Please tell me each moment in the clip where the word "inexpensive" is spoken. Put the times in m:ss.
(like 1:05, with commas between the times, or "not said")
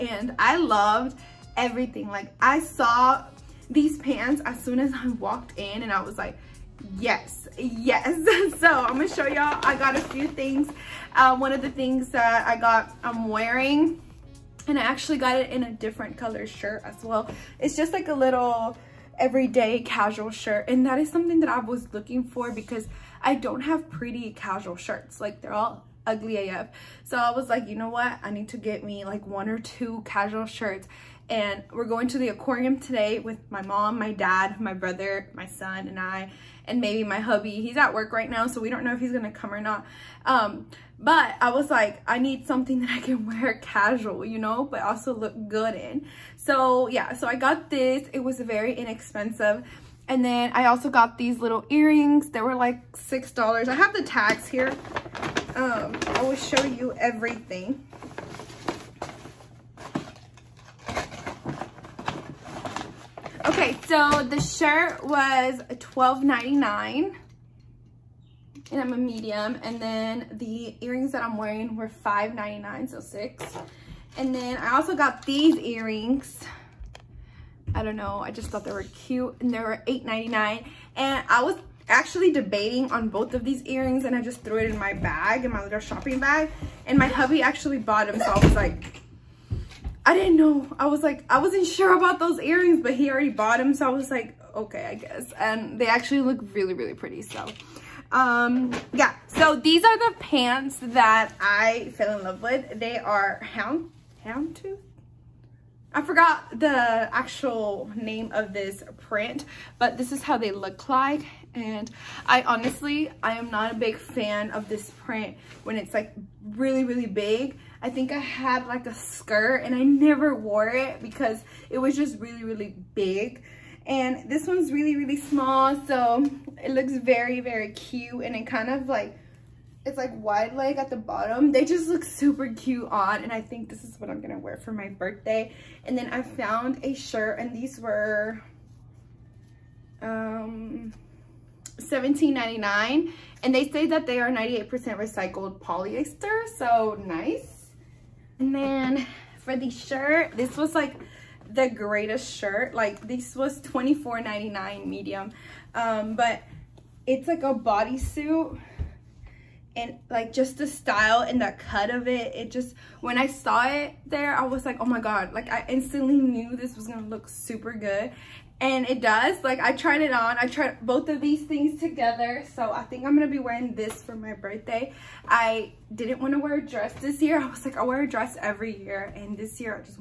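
0:48.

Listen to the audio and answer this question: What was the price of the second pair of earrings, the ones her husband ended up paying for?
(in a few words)
$8.99.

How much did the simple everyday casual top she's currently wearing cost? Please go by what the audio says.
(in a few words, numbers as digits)
$12.99.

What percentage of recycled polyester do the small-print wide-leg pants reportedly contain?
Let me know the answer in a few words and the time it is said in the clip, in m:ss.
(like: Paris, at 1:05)
98%, at 2:24.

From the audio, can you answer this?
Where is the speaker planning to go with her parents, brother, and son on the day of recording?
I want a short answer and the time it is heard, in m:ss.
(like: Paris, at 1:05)
the aquarium, at 0:32.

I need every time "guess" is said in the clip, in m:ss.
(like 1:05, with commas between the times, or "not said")
1:34.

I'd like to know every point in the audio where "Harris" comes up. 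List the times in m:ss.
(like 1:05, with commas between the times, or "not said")
not said.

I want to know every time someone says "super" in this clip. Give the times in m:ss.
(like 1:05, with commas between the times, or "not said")
2:12, 2:47.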